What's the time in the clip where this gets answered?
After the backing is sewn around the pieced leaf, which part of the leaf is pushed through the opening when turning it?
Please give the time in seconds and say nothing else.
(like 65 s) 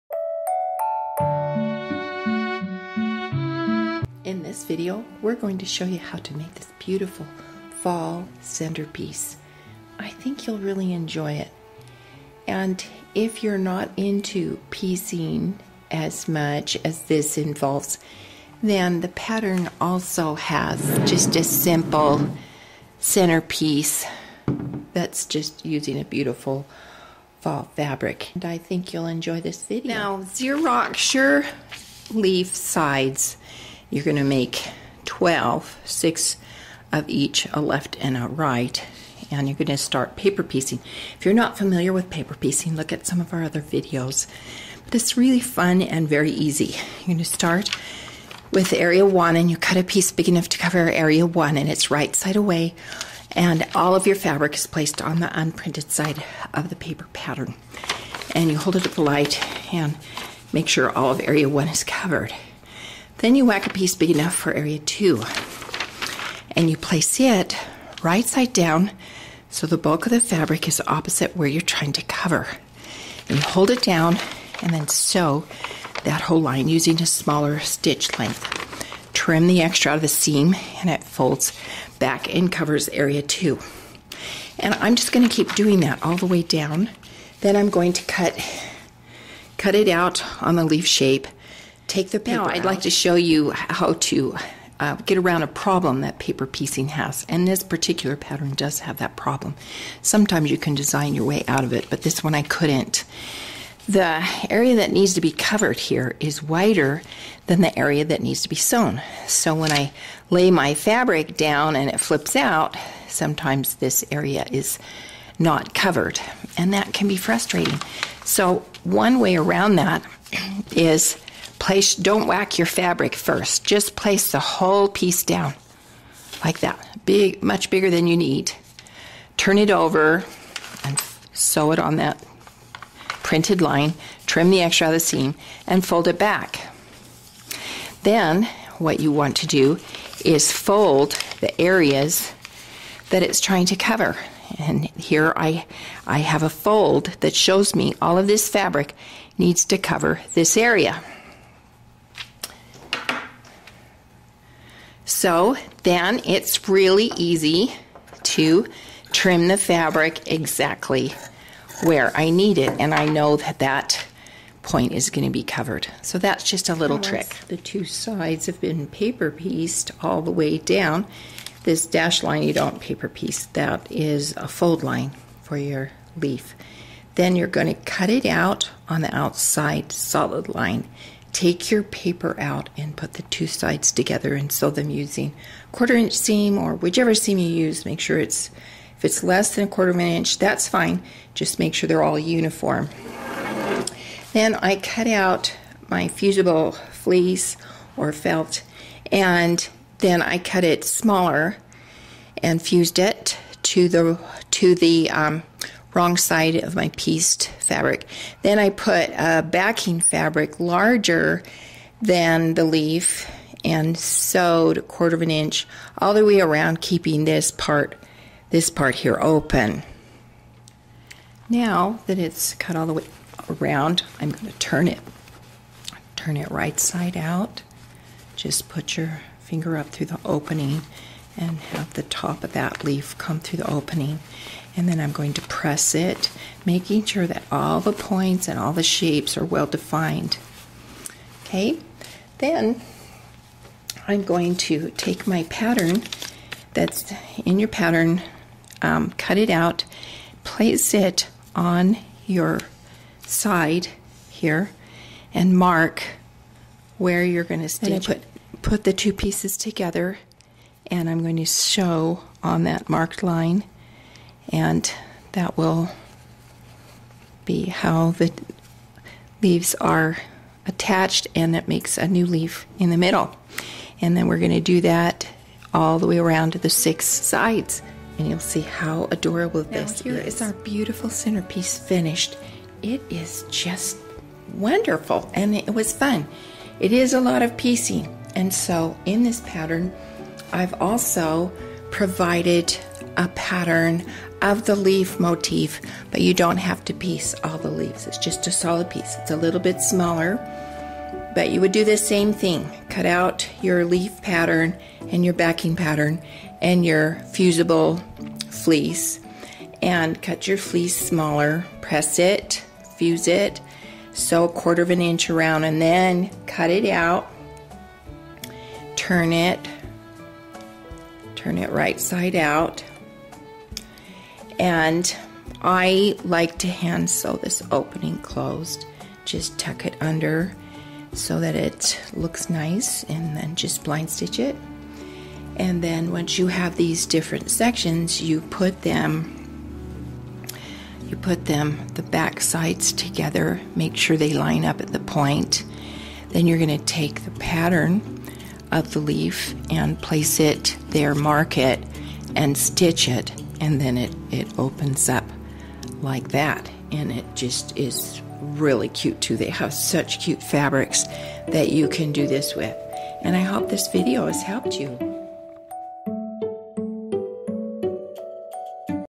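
231 s.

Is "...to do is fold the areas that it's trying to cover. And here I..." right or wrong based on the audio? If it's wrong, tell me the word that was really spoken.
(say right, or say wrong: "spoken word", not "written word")
right.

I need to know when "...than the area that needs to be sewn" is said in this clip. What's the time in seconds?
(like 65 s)
107 s.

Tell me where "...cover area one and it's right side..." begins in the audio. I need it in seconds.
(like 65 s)
50 s.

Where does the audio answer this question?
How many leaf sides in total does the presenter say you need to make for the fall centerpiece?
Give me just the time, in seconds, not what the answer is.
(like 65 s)
35 s.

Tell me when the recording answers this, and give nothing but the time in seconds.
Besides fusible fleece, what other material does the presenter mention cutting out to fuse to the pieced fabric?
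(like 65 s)
198 s.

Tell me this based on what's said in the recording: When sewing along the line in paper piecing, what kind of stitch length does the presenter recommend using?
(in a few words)
smaller stitch length.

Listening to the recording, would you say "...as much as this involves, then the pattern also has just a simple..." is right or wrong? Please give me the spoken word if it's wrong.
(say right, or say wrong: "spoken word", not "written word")
right.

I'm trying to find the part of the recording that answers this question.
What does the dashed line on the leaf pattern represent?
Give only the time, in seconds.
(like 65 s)
174 s.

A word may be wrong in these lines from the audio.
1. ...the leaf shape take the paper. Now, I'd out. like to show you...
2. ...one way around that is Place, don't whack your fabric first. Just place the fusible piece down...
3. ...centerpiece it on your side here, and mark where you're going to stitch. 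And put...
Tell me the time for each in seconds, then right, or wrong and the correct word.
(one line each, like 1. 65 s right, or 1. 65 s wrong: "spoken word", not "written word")
1. 90 s right
2. 118 s wrong: "whole", not "fusible"
3. 250 s wrong: "place", not "centerpiece".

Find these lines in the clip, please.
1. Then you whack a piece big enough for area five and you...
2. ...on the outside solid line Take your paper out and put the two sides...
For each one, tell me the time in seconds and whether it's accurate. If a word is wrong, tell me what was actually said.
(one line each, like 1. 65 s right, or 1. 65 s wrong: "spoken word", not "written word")
1. 63 s wrong: "two", not "five"
2. 178 s right.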